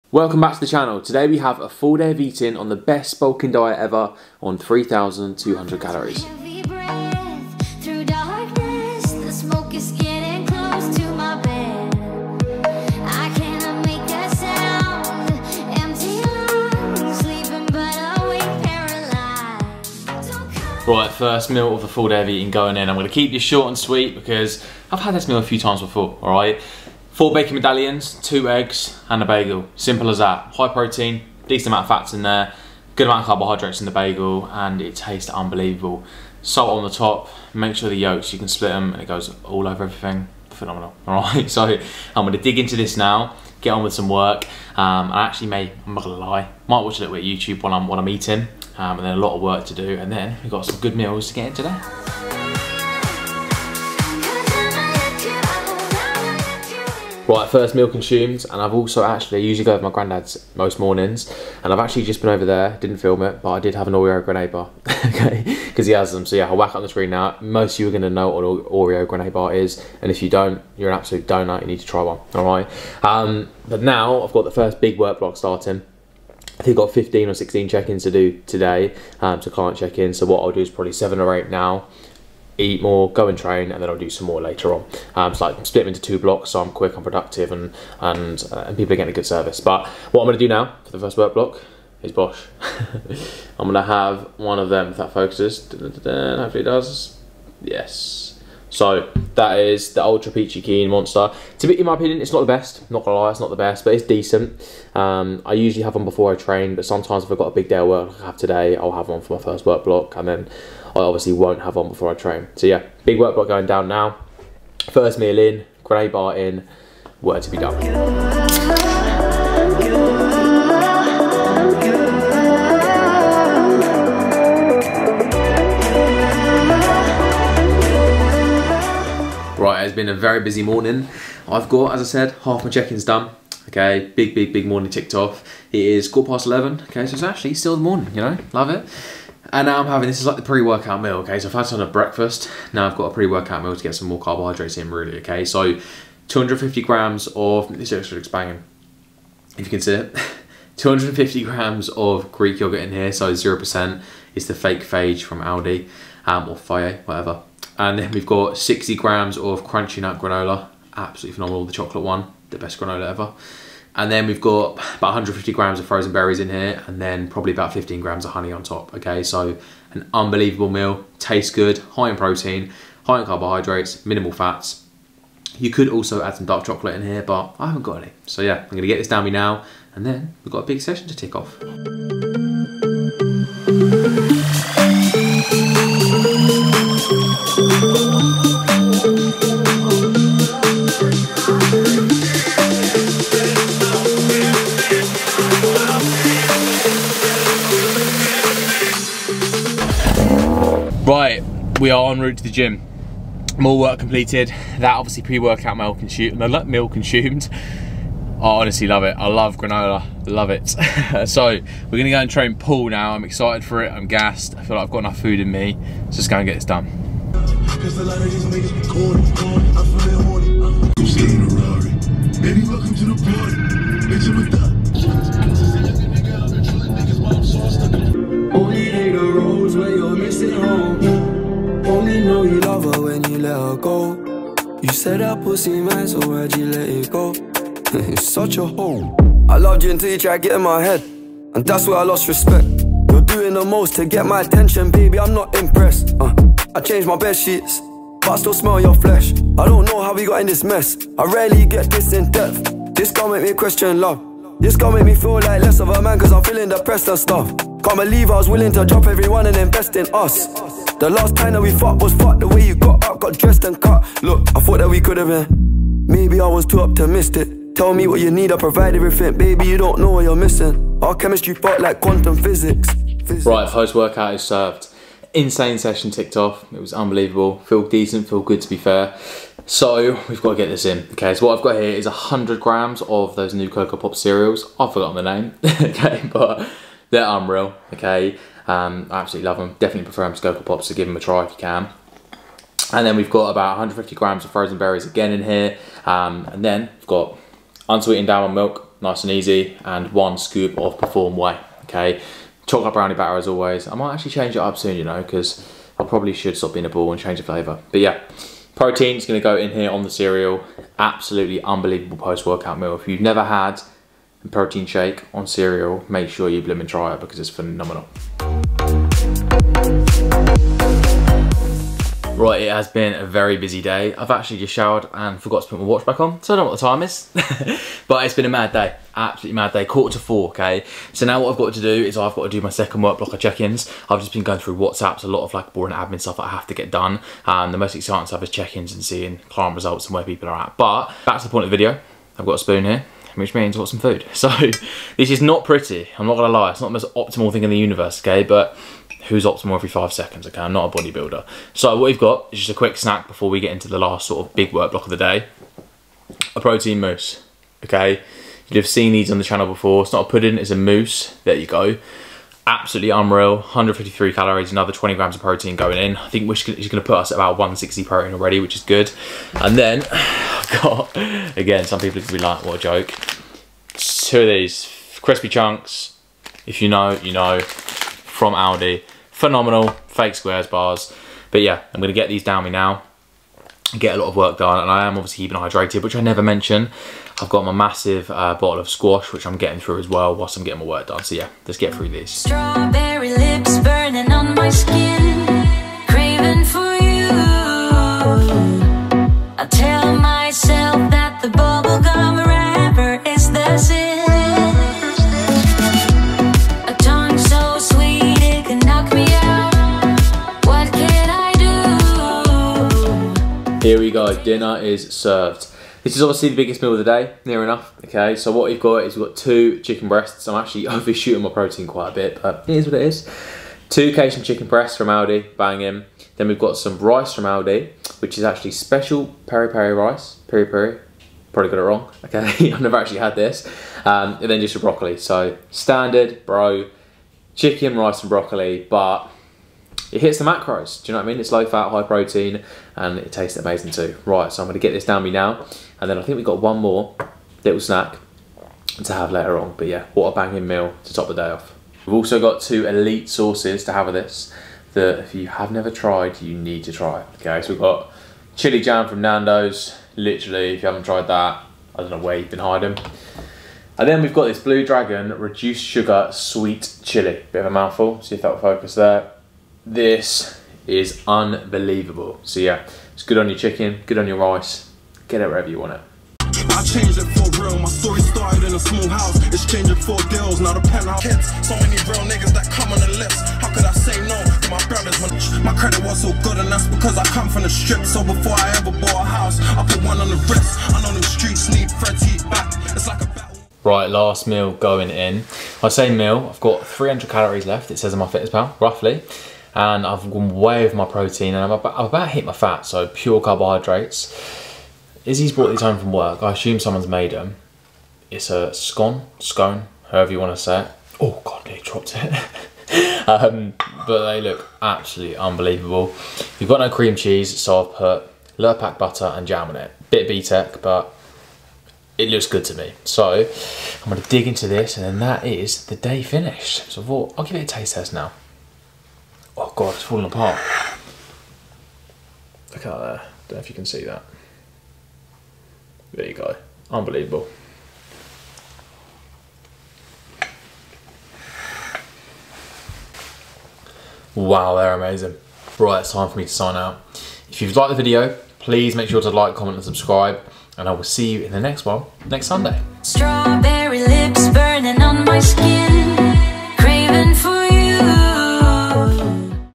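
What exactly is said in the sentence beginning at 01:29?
But what I'm going to do now for the first work block is Bosch.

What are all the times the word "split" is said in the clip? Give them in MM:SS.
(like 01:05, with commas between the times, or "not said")
00:38, 01:25.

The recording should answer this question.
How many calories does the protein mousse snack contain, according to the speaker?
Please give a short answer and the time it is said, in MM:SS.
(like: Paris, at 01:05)
153, at 06:03.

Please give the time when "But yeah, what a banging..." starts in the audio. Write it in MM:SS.
07:29.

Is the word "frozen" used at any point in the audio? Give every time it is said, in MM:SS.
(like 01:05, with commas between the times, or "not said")
02:45, 04:54.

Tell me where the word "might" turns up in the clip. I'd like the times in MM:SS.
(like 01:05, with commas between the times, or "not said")
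00:46, 05:03.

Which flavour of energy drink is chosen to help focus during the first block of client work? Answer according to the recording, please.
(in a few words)
Ultra Peachy Keen.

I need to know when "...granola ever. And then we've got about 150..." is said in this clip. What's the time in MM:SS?
02:42.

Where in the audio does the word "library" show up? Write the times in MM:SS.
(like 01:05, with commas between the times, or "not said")
not said.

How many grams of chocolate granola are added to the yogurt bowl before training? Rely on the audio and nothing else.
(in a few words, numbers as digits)
60 grams.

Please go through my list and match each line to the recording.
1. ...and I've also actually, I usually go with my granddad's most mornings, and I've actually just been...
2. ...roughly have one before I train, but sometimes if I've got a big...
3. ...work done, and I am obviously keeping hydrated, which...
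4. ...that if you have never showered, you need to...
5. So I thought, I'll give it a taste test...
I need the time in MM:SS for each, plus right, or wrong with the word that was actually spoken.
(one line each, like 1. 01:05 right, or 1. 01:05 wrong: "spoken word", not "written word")
1. 00:58 right
2. 01:45 wrong: "usually", not "roughly"
3. 06:24 right
4. 07:34 wrong: "tried", not "showered"
5. 08:46 right.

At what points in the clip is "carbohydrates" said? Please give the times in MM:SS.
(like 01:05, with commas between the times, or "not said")
00:33, 02:24, 02:53, 08:23.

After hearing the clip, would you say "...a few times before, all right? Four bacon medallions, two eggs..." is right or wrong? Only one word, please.
right.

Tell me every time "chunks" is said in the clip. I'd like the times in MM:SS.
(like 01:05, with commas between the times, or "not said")
06:15.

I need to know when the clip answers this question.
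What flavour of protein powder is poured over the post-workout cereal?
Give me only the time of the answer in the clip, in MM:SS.
05:02.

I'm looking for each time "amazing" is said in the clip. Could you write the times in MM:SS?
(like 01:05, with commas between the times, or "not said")
07:23, 09:04.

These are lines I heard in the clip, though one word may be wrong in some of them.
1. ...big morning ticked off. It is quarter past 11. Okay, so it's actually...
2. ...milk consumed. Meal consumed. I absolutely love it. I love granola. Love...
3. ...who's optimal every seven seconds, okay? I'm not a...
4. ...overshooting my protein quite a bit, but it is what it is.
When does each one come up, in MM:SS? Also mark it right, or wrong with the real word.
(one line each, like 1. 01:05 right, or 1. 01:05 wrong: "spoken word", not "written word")
1. 02:14 right
2. 03:25 wrong: "honestly", not "absolutely"
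3. 05:49 wrong: "five", not "seven"
4. 07:00 right.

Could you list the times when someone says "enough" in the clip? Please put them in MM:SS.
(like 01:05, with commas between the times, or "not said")
03:34, 06:57.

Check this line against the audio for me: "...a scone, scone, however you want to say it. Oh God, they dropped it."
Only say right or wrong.
right.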